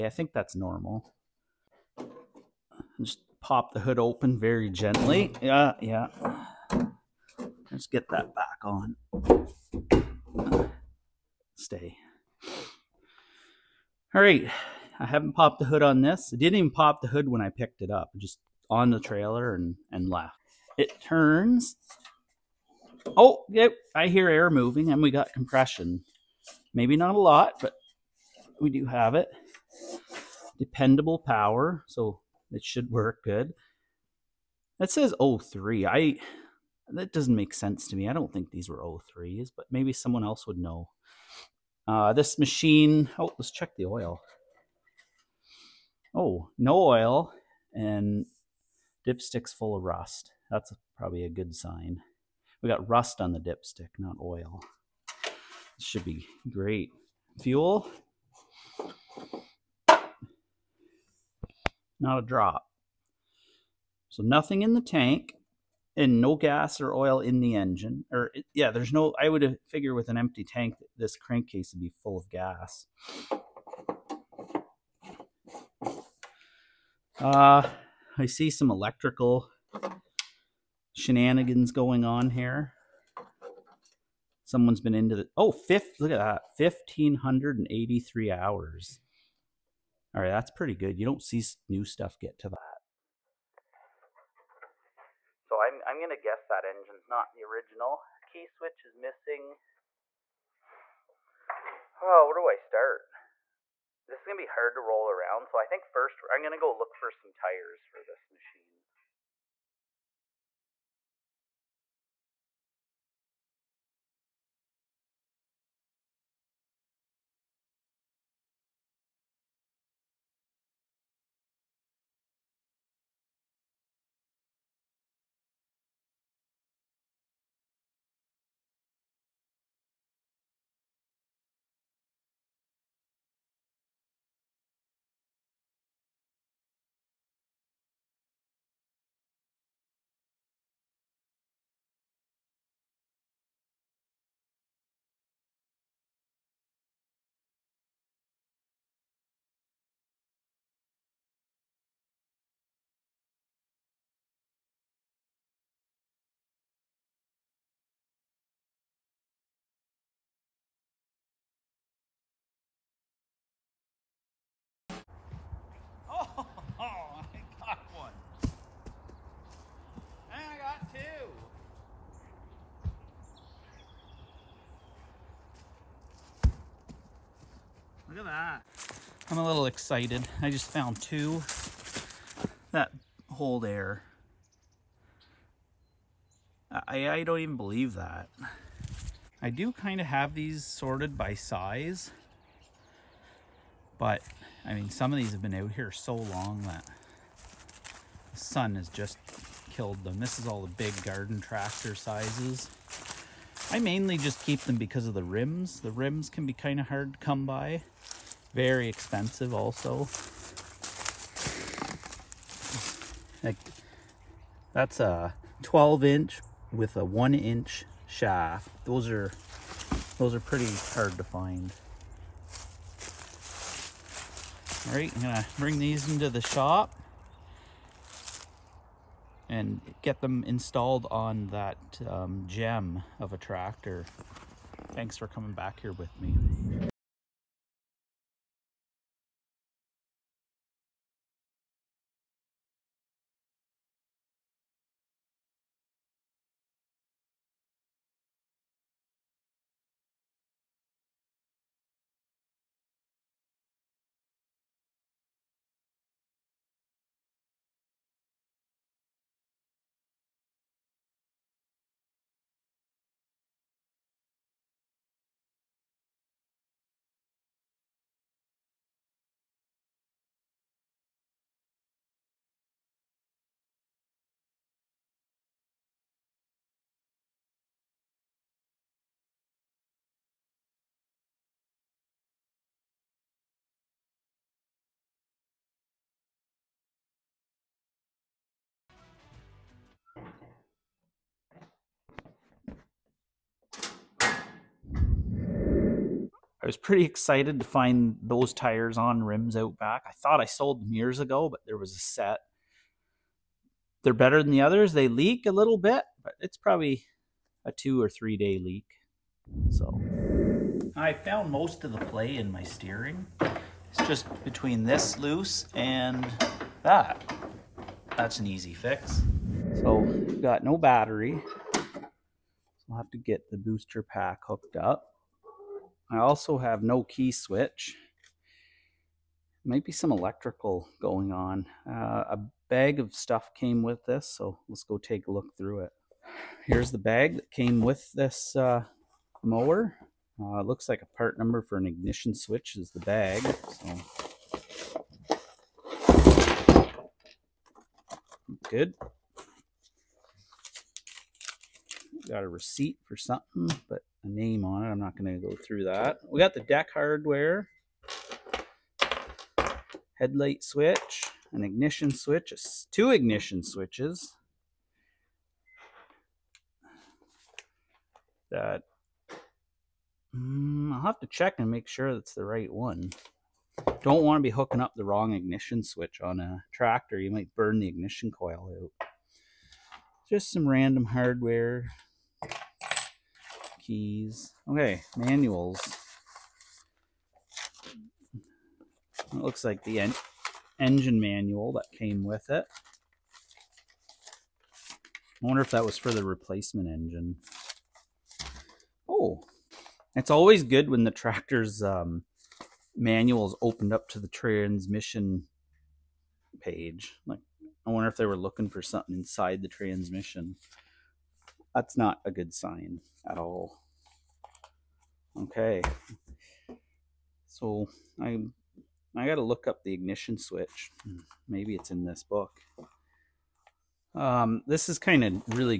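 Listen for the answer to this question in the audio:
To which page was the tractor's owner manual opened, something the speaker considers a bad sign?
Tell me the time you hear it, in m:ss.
6:44.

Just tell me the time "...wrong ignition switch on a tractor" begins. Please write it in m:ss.
6:15.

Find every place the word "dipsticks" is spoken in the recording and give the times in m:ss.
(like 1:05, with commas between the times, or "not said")
0:49, 0:53.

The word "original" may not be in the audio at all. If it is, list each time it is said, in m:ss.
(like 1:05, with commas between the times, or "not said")
1:37.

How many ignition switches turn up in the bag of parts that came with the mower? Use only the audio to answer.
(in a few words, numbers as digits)
2.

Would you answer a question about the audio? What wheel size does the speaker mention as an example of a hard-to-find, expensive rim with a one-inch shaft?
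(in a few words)
12 inch.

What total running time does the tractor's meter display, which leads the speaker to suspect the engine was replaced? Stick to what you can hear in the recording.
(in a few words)
1583 hours.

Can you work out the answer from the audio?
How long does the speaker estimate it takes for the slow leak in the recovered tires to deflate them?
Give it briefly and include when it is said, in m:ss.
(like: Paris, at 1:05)
2 or 3 days, at 5:07.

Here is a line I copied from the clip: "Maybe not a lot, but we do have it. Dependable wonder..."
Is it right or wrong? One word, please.
wrong.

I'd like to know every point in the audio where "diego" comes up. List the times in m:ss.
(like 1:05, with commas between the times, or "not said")
not said.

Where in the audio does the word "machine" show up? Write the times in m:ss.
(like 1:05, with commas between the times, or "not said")
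0:42, 1:48.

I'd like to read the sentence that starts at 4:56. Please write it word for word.
I was pretty excited to find those tires on rims out back.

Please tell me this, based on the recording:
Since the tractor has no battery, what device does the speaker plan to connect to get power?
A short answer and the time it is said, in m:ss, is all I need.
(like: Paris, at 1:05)
Booster pack, at 5:23.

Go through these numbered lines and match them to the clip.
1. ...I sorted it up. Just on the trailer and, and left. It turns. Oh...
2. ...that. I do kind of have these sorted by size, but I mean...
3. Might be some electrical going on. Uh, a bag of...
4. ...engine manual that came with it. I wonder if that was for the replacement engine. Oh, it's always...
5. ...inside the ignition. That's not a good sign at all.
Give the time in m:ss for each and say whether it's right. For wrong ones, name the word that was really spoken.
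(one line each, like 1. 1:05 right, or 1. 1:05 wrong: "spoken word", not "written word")
1. 0:17 wrong: "picked", not "sorted"
2. 3:07 right
3. 5:29 right
4. 6:30 right
5. 6:49 wrong: "transmission", not "ignition".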